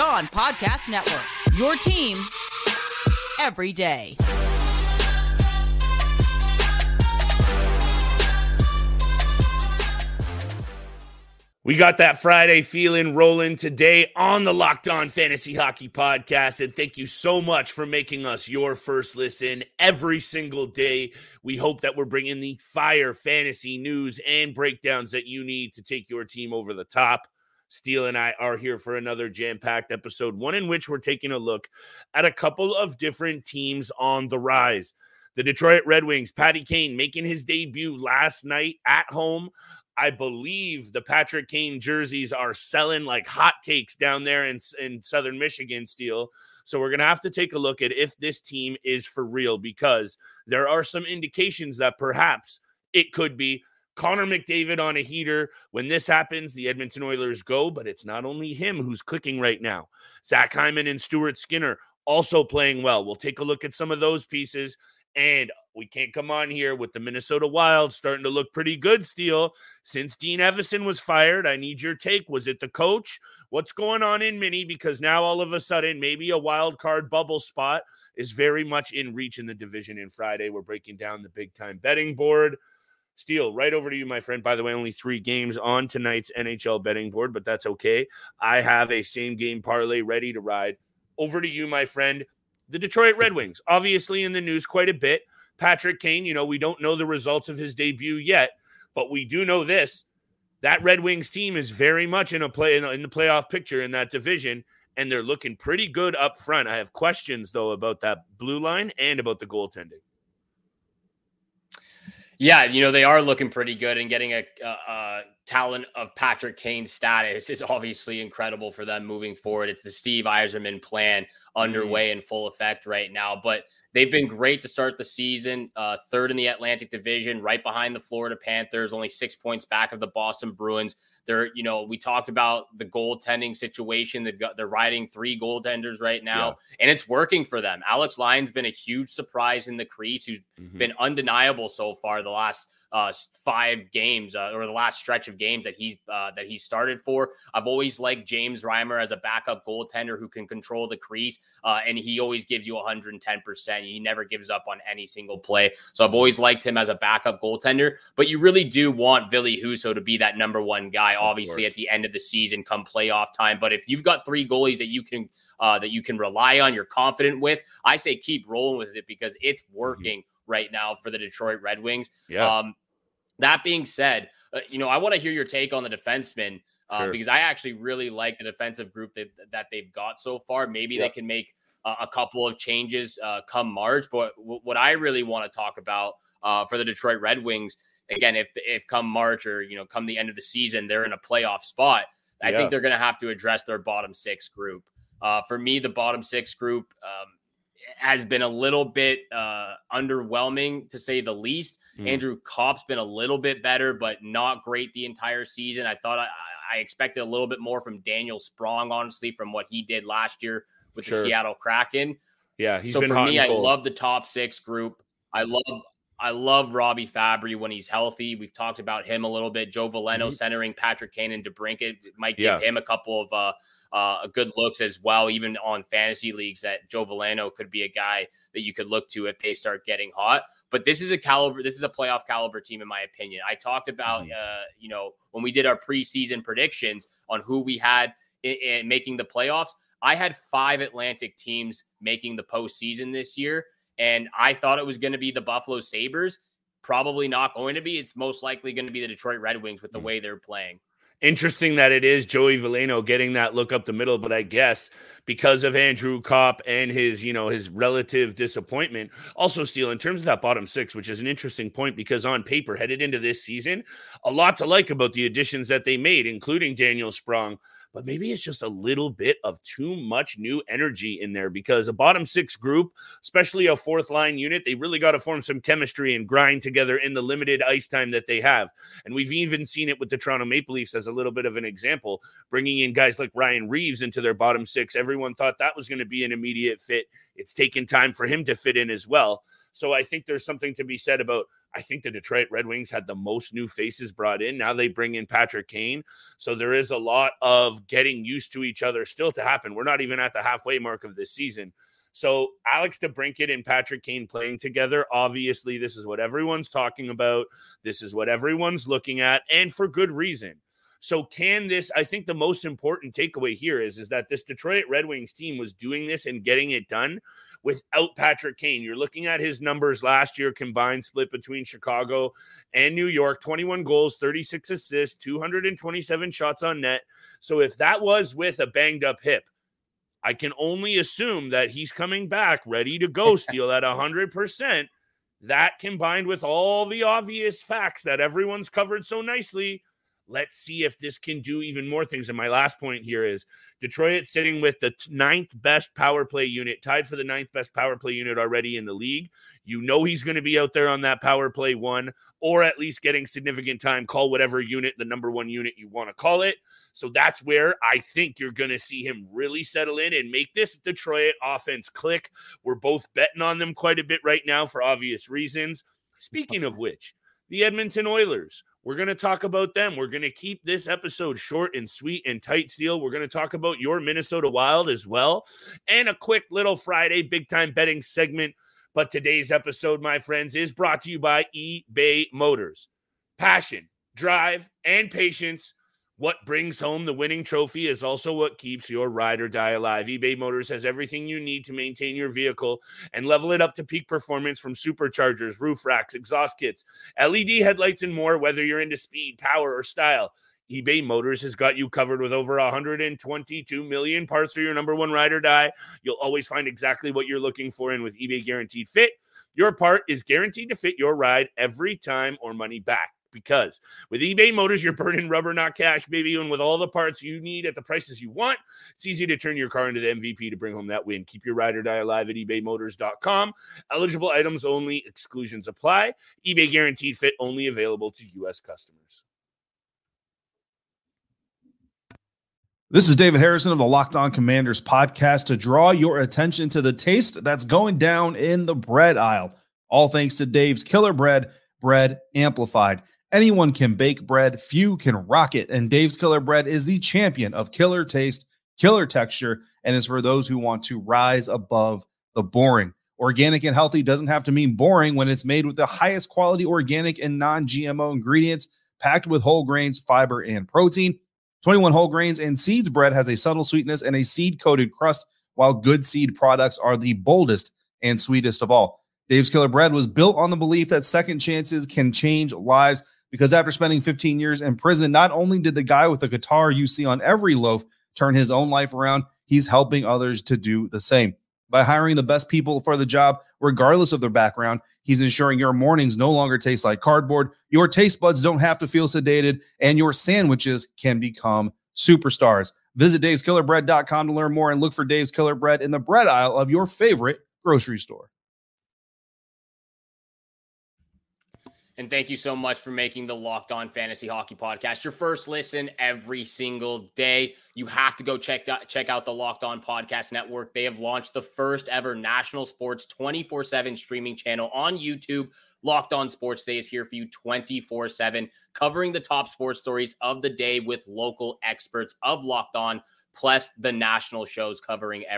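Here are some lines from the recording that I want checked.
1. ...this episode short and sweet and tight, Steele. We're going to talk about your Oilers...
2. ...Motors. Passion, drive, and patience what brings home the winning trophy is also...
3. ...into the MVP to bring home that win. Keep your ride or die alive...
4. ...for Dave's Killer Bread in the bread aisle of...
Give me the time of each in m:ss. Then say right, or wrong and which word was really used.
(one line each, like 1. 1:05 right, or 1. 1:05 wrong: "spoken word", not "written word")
1. 6:10 wrong: "Minnesota", not "Oilers"
2. 6:22 right
3. 6:59 right
4. 8:14 right.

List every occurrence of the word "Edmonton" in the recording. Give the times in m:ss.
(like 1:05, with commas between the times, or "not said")
0:56, 6:07.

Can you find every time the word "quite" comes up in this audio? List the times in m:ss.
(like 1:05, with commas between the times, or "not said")
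1:34, 6:03.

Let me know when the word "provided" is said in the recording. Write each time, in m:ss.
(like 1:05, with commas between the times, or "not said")
not said.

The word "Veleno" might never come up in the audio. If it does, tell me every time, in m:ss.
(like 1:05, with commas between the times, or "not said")
3:39, 3:47, 4:12.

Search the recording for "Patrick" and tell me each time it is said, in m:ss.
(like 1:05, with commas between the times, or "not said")
0:41, 1:35, 1:56, 3:40, 4:55, 5:03, 5:18.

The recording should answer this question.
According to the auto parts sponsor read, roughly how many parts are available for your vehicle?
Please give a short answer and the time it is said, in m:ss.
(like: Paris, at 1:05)
122 million, at 6:42.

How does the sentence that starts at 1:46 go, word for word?
I have questions though about that blue line and about the goaltending.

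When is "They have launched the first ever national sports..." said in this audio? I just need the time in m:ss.
8:30.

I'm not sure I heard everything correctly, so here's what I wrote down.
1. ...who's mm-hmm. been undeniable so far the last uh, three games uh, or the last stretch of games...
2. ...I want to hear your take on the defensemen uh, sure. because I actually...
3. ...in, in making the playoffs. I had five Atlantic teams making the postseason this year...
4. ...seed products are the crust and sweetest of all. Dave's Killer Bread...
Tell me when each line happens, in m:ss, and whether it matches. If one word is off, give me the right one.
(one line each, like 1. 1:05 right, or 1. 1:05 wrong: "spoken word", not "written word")
1. 2:20 wrong: "five", not "three"
2. 2:54 right
3. 3:58 right
4. 7:46 wrong: "boldest", not "crust".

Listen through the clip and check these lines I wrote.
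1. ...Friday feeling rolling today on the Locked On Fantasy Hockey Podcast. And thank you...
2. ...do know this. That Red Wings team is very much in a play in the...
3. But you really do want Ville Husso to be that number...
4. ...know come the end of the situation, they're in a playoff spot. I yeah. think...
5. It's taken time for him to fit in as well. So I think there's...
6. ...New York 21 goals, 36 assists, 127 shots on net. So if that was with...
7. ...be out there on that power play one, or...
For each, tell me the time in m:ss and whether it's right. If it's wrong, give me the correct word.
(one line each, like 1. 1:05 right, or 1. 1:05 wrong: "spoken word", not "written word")
1. 0:12 right
2. 1:39 right
3. 2:38 right
4. 3:09 wrong: "season", not "situation"
5. 4:47 right
6. 5:22 wrong: "227", not "127"
7. 5:50 right.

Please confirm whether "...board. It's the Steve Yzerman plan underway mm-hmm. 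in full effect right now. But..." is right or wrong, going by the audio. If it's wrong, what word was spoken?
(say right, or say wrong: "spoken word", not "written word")
wrong: "forward", not "board".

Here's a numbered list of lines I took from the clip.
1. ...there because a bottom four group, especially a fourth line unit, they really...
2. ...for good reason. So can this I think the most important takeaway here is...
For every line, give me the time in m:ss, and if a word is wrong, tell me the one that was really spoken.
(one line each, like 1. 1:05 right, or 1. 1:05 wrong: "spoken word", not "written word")
1. 4:31 wrong: "six", not "four"
2. 5:09 right.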